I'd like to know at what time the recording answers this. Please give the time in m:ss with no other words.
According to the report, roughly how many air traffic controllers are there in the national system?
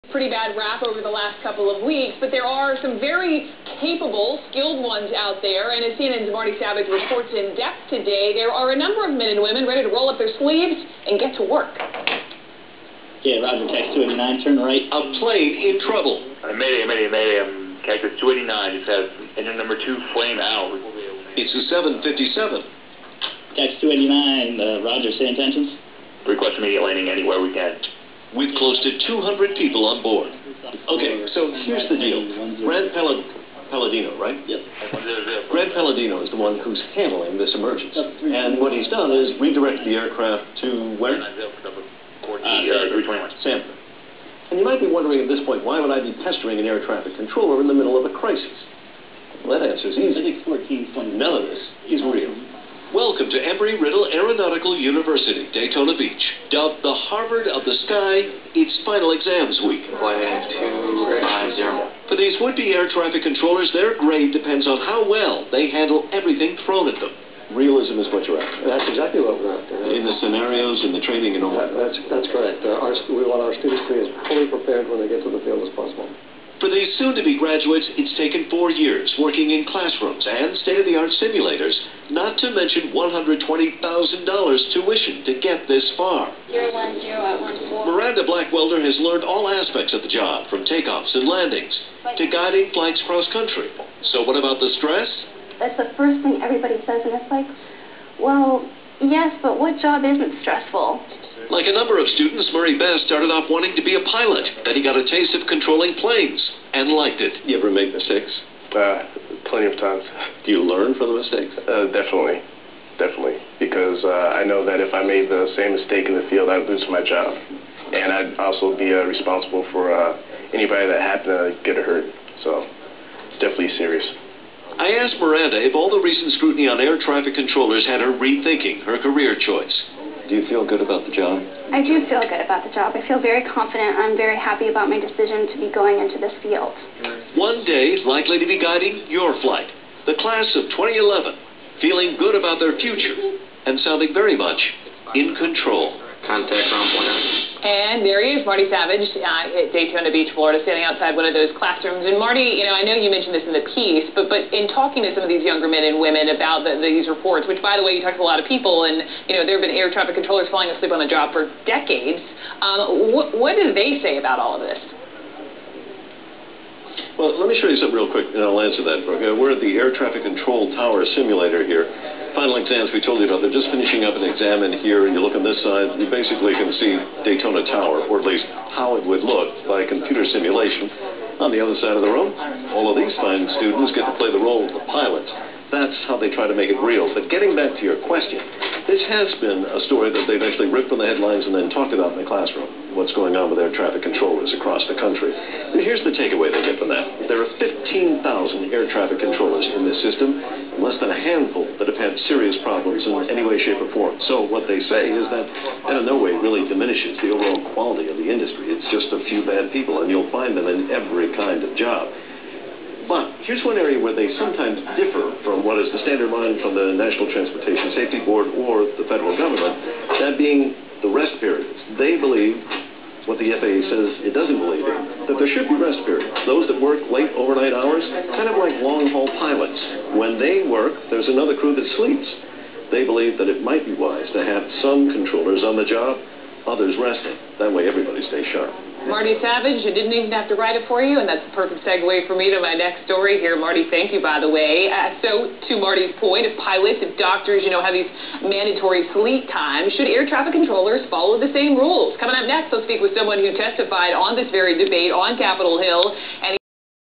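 3:17.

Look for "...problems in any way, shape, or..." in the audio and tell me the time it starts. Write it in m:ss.
3:22.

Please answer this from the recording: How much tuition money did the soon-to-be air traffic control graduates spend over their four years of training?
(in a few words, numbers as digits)
$120,000.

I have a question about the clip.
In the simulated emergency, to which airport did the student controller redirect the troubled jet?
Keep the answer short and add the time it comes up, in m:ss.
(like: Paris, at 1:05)
Sanford, at 0:43.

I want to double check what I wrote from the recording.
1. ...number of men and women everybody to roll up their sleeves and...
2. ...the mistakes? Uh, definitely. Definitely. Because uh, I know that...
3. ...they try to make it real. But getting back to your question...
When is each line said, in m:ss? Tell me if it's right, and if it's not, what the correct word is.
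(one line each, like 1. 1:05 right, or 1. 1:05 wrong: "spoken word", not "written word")
1. 0:08 wrong: "ready", not "everybody"
2. 1:51 right
3. 3:06 right.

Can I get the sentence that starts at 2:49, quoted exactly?
We're at the Air Traffic Control Tower simulator here.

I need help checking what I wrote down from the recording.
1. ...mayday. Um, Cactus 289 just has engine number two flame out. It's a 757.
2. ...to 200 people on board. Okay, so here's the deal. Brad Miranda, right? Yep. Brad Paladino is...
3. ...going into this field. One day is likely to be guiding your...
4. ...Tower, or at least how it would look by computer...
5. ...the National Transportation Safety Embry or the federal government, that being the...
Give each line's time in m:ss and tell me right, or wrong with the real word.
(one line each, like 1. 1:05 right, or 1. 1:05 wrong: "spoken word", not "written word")
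1. 0:17 right
2. 0:28 wrong: "Paladino", not "Miranda"
3. 2:15 right
4. 2:57 right
5. 3:36 wrong: "Board", not "Embry".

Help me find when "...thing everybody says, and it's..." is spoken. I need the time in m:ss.
1:36.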